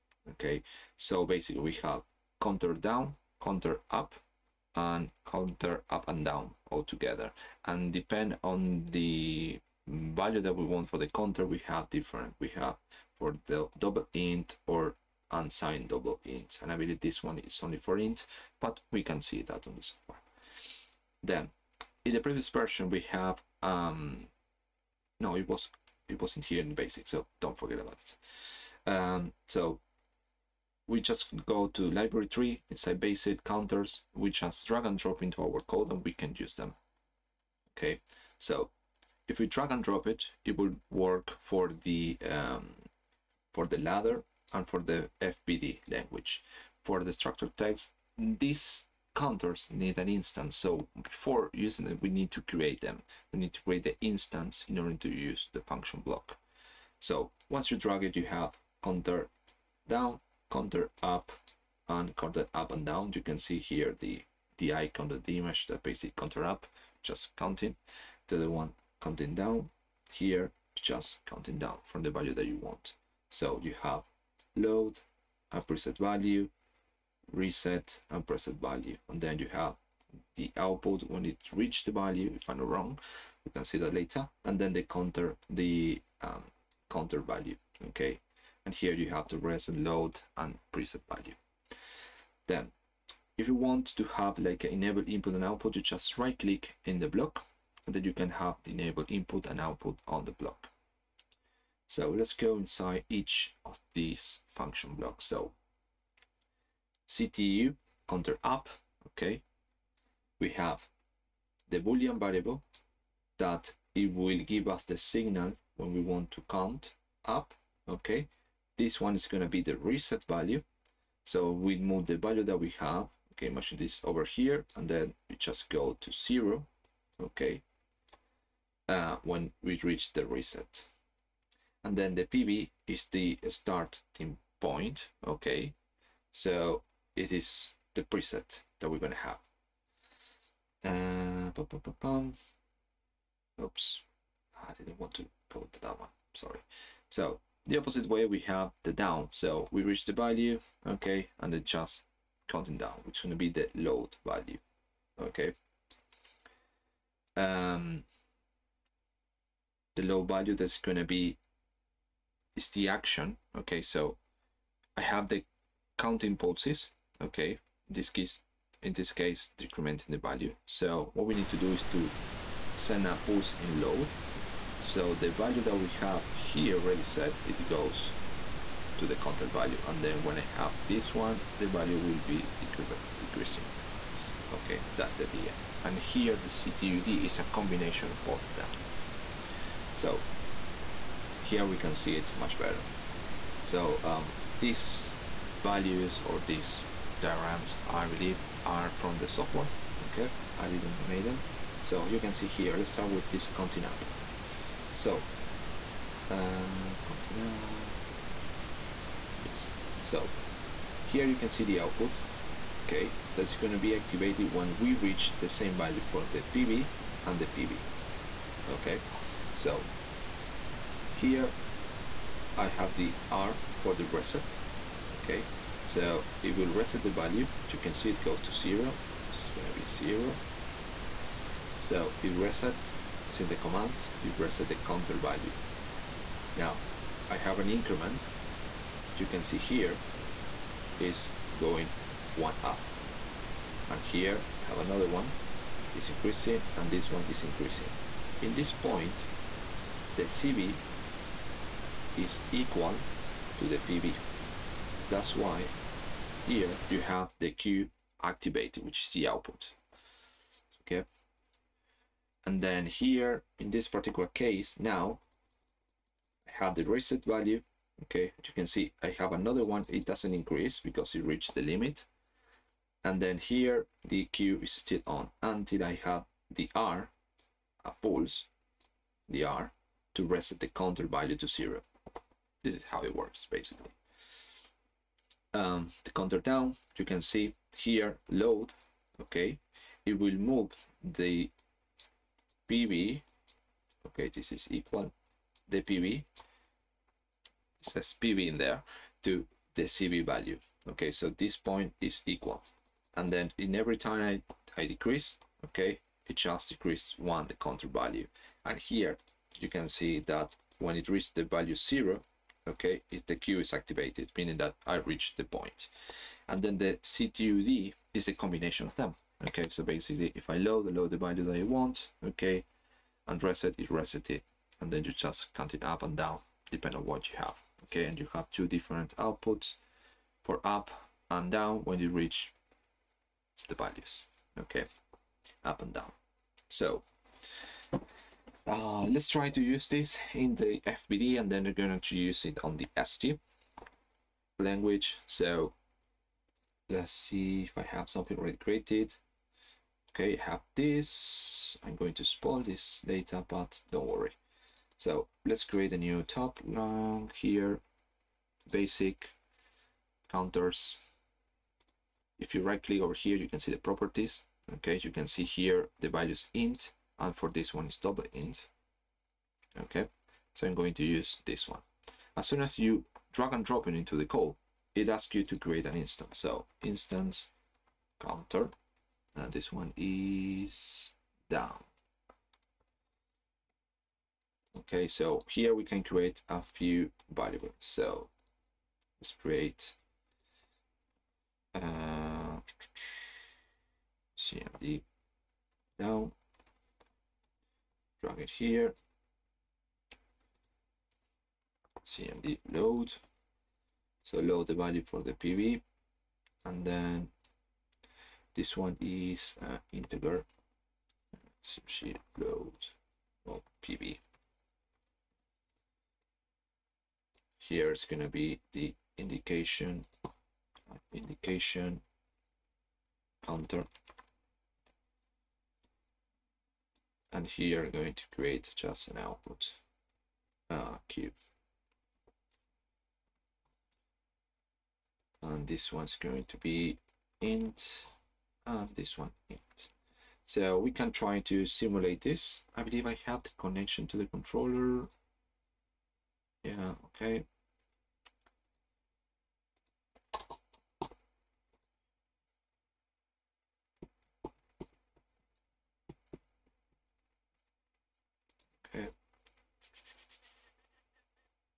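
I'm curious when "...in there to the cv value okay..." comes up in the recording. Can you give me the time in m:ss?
4:58.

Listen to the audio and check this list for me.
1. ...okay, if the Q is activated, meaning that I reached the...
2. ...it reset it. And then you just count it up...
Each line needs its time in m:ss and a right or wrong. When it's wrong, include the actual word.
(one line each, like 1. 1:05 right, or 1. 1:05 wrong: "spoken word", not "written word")
1. 5:12 right
2. 5:23 right.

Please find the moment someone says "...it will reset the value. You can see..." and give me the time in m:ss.
3:46.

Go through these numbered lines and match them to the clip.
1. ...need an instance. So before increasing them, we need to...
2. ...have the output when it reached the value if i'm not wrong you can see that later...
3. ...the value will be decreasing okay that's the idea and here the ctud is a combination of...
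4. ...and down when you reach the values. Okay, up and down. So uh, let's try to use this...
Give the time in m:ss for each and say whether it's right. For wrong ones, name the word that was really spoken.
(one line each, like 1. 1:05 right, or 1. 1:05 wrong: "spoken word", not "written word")
1. 0:49 wrong: "using", not "increasing"
2. 1:19 right
3. 3:01 right
4. 5:31 right.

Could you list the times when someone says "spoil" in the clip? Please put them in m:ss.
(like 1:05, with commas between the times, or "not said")
5:52.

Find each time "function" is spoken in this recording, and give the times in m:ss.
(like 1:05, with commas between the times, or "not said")
0:55, 1:44.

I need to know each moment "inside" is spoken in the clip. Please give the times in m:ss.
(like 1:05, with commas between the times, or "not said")
0:32, 1:42.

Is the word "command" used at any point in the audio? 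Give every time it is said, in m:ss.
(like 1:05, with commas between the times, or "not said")
3:53.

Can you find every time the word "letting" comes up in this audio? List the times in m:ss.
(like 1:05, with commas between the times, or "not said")
not said.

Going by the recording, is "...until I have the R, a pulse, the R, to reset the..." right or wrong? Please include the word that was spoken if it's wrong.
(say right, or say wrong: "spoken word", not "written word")
right.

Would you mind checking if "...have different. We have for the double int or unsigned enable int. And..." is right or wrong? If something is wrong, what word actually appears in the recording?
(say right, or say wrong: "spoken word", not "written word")
wrong: "double", not "enable".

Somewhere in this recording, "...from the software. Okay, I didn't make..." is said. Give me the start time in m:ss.
3:18.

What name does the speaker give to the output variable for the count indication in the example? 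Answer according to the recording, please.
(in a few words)
indication counter.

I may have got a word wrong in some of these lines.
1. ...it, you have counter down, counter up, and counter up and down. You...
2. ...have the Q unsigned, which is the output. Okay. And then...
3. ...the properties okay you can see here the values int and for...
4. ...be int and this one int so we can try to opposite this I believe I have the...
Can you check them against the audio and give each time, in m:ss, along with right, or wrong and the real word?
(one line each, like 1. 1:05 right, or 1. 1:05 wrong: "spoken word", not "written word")
1. 0:58 right
2. 4:17 wrong: "activated", not "unsigned"
3. 6:03 right
4. 7:16 wrong: "simulate", not "opposite".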